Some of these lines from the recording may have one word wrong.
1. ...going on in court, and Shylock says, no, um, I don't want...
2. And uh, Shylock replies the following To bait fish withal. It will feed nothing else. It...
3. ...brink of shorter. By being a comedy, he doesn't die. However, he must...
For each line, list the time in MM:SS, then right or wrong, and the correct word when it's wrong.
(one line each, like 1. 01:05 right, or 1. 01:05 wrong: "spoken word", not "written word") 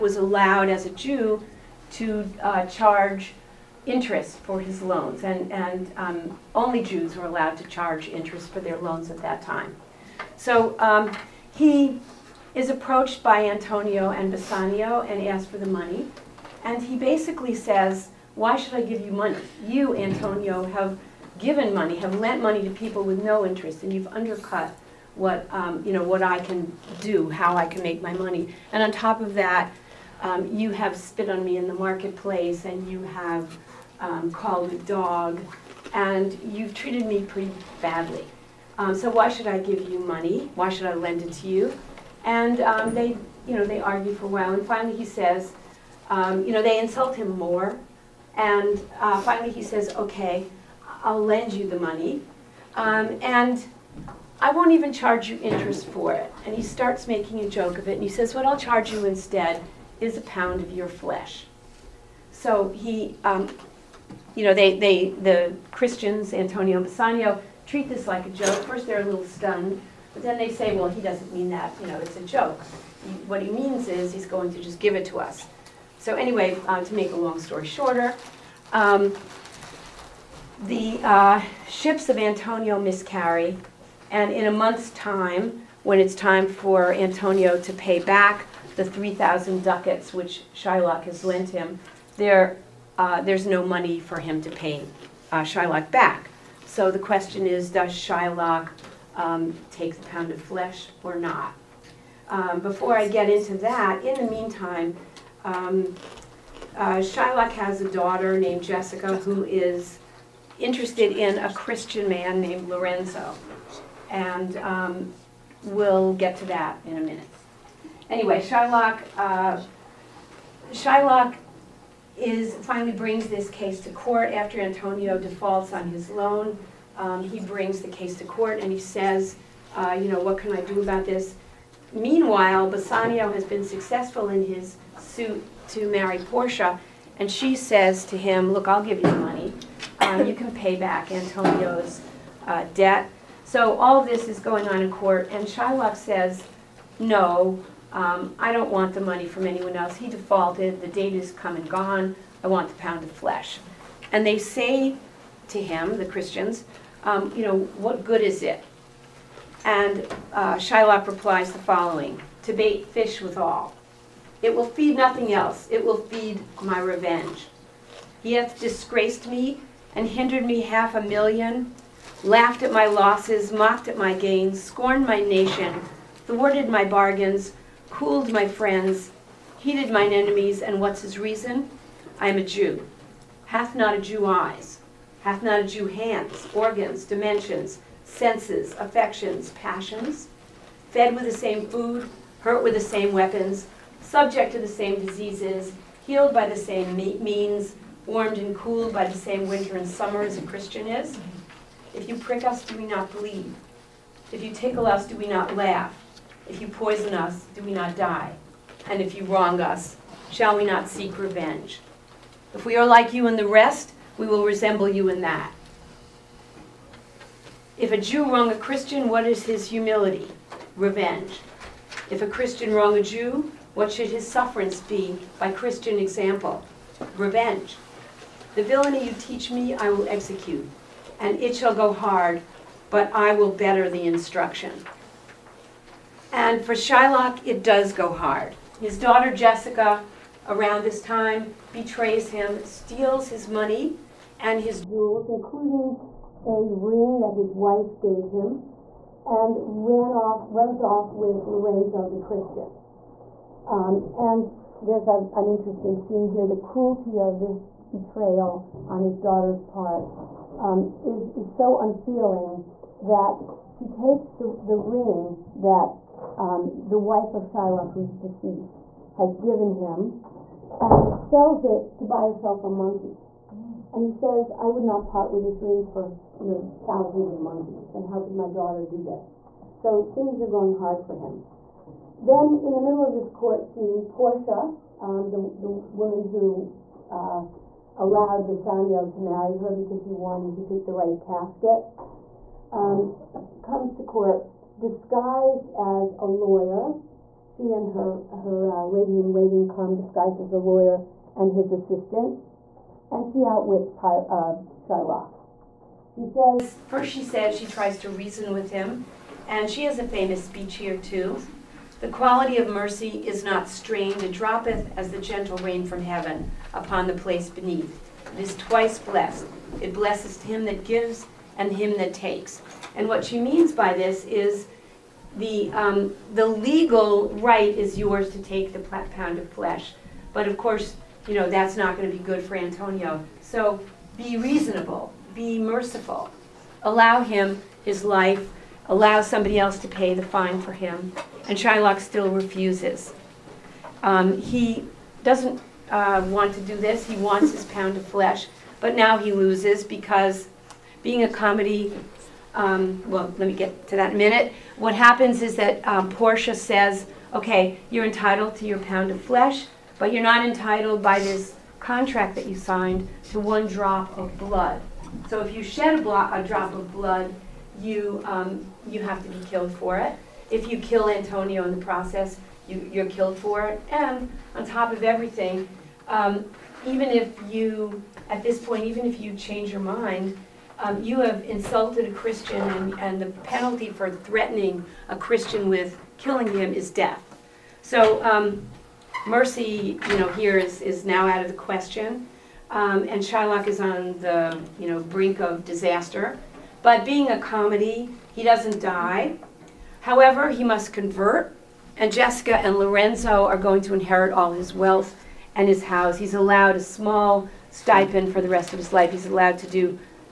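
1. 02:24 right
2. 02:39 right
3. 06:34 wrong: "disaster", not "shorter".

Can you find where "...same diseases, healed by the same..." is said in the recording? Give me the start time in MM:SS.
03:14.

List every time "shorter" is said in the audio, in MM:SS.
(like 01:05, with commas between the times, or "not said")
01:17.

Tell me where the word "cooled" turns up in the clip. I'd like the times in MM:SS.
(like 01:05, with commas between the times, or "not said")
02:57, 03:18.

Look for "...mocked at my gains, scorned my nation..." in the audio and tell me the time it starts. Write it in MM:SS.
02:53.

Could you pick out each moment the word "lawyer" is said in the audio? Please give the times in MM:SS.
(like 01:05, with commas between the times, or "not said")
04:56, 05:00.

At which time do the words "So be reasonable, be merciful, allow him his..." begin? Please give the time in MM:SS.
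05:33.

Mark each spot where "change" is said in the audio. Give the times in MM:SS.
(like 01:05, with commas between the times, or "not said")
06:19.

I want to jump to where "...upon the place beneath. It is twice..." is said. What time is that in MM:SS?
05:16.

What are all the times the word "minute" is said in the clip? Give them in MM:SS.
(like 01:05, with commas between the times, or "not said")
01:56, 05:54.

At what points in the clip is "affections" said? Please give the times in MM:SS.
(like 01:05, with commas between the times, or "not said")
03:08.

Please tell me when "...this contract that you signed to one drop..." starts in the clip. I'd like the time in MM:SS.
06:01.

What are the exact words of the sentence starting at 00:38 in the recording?
Um, so why should I give you money?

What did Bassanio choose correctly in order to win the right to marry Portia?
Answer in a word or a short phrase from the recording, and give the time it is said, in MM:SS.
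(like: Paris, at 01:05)
The right casket, at 04:50.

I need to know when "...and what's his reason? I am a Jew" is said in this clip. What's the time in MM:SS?
03:00.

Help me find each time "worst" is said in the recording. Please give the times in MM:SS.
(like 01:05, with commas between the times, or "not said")
not said.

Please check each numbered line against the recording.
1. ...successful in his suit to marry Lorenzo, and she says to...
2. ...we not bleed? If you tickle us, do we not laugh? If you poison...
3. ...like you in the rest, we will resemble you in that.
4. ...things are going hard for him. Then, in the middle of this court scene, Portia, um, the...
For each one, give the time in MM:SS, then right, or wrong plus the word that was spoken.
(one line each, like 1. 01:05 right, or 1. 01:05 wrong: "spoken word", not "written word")
1. 02:13 wrong: "Portia", not "Lorenzo"
2. 03:22 right
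3. 03:32 right
4. 04:40 right.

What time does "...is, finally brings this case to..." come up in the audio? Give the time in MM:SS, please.
02:02.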